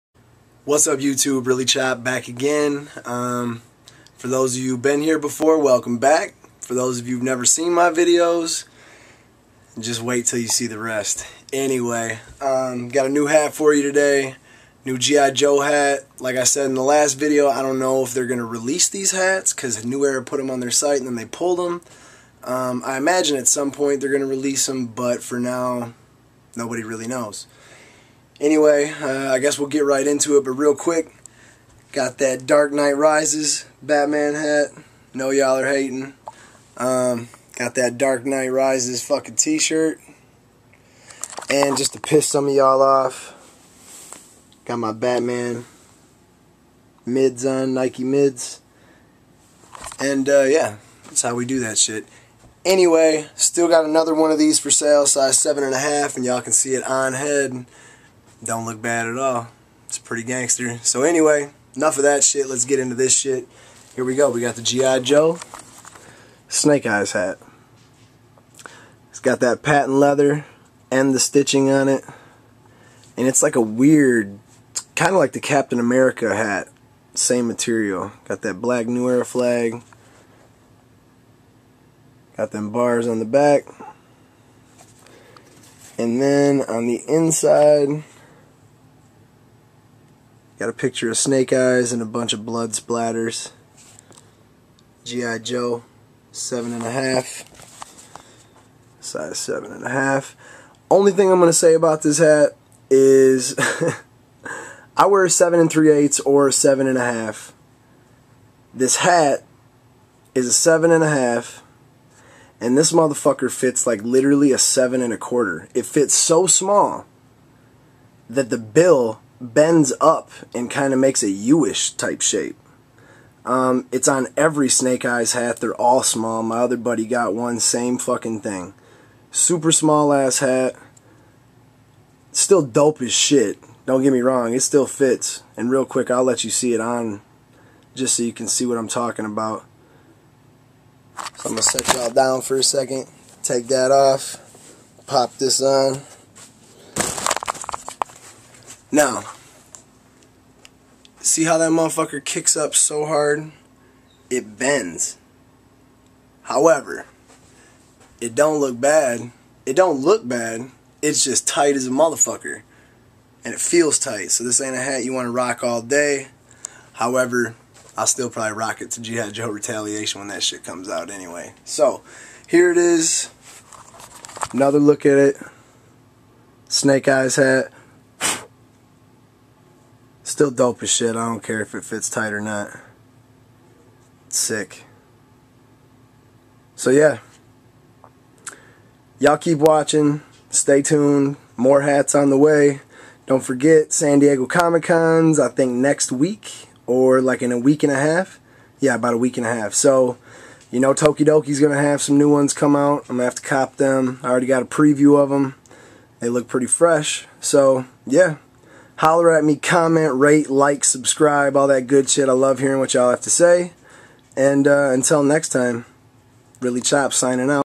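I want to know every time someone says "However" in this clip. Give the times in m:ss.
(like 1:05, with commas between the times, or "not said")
2:36, 2:46.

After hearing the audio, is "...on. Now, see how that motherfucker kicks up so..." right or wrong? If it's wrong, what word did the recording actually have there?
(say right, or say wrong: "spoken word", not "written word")
right.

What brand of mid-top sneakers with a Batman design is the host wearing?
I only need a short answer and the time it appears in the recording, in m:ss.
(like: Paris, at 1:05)
Nike, at 0:47.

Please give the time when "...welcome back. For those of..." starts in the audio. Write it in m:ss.
0:05.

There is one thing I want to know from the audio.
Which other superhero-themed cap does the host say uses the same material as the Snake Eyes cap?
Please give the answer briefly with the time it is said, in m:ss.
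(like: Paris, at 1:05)
Captain America, at 1:15.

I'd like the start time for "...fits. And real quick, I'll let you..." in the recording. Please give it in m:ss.
2:14.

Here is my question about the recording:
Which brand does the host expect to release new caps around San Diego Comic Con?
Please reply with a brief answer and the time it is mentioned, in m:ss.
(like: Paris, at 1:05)
Tokidoki, at 3:20.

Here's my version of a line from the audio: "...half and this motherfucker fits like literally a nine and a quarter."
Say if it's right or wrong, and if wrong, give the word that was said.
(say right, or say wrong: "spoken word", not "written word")
wrong: "seven", not "nine".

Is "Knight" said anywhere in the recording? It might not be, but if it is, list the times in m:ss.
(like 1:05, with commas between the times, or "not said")
0:32, 0:38.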